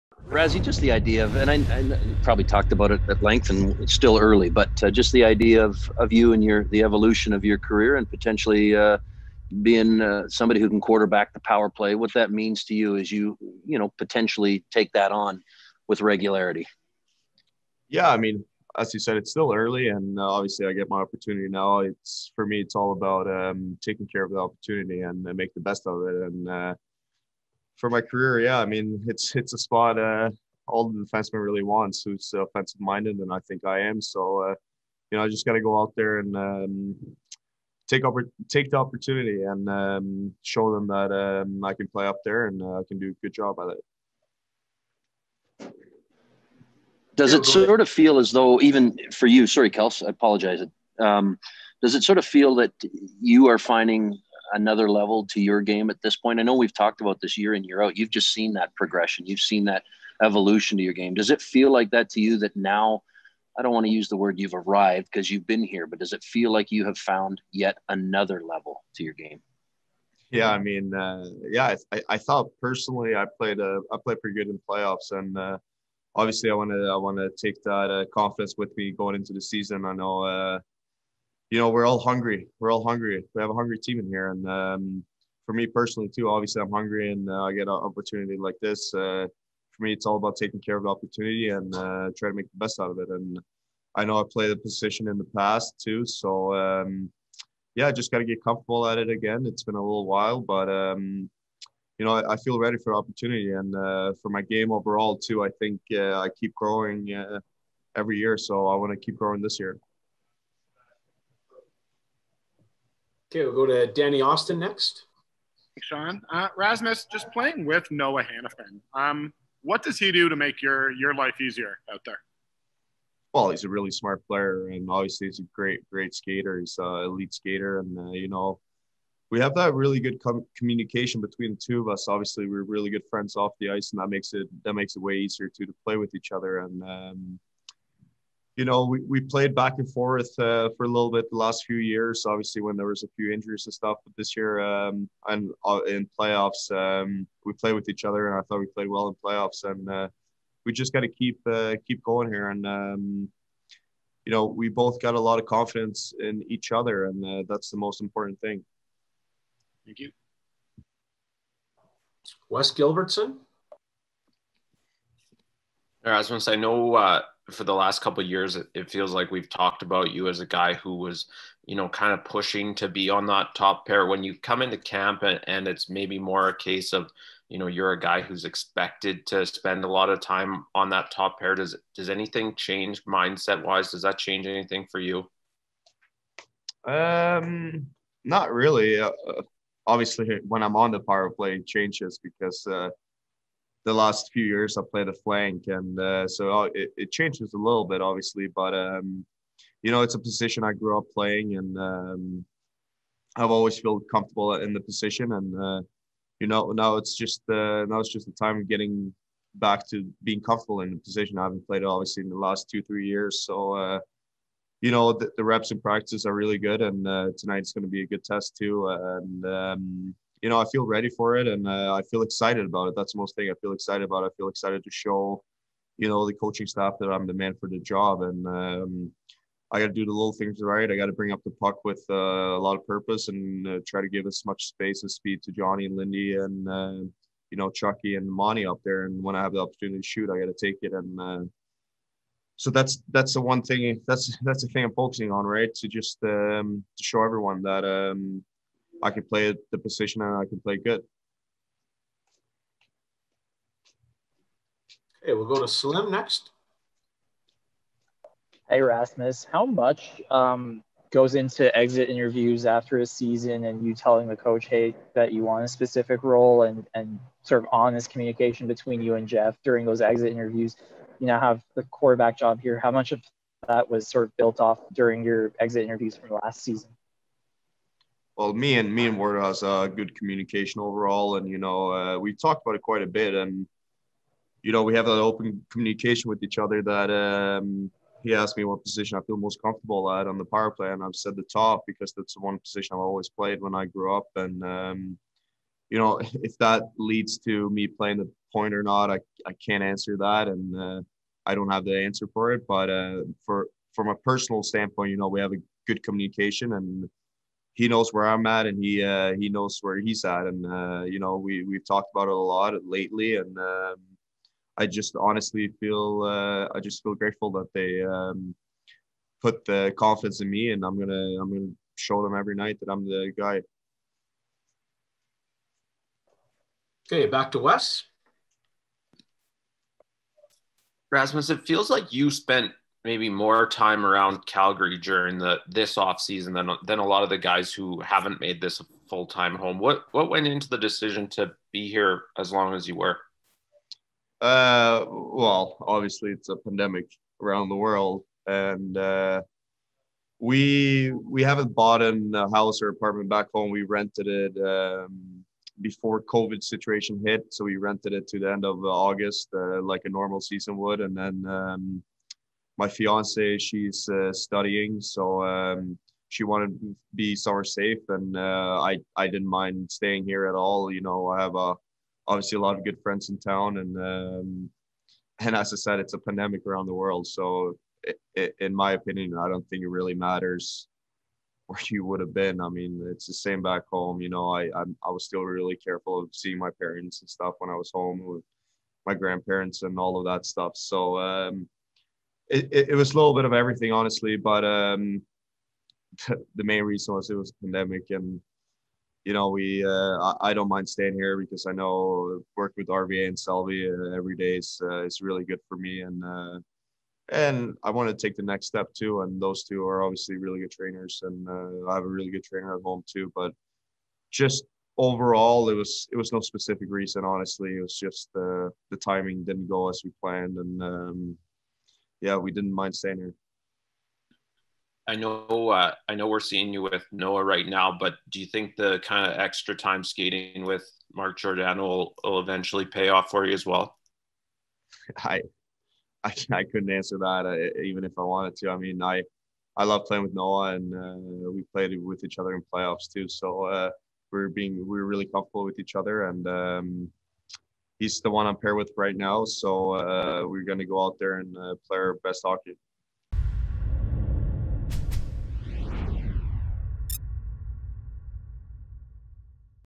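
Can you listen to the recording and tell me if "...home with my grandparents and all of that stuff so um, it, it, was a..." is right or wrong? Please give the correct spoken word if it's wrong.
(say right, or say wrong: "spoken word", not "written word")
right.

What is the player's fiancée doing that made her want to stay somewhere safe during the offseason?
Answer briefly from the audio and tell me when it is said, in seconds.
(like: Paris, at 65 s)
studying, at 364 s.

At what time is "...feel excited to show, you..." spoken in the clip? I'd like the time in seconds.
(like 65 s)
224 s.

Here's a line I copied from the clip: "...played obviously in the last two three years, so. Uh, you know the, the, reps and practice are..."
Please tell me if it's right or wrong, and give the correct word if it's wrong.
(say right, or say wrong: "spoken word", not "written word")
right.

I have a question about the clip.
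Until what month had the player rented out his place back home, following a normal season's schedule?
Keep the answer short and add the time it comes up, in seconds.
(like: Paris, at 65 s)
August, at 358 s.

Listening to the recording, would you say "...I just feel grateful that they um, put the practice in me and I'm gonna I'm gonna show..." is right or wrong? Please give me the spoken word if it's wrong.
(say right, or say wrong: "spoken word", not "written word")
wrong: "confidence", not "practice".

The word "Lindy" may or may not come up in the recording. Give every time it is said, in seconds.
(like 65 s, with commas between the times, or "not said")
235 s.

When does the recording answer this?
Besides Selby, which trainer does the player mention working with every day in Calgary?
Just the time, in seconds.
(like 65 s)
402 s.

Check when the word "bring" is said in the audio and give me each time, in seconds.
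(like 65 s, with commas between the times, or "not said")
231 s.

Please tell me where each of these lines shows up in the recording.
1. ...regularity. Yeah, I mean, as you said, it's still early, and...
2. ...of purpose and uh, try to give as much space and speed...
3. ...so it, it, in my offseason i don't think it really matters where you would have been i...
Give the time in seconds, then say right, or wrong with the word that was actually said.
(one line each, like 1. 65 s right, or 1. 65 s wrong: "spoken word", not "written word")
1. 16 s right
2. 232 s right
3. 377 s wrong: "opinion", not "offseason".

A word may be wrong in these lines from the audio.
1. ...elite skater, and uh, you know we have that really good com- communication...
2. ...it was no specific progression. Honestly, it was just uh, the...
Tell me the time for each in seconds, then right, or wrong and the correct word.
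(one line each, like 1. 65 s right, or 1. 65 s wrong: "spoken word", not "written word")
1. 127 s right
2. 416 s wrong: "reason", not "progression".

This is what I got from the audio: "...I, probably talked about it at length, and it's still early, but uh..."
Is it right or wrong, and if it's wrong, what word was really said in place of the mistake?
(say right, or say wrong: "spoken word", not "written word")
right.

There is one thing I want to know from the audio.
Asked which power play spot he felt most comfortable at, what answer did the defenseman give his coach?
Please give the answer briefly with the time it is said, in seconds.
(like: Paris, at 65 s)
the top, at 291 s.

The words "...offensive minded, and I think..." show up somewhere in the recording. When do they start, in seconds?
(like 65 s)
32 s.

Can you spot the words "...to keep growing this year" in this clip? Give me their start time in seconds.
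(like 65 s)
108 s.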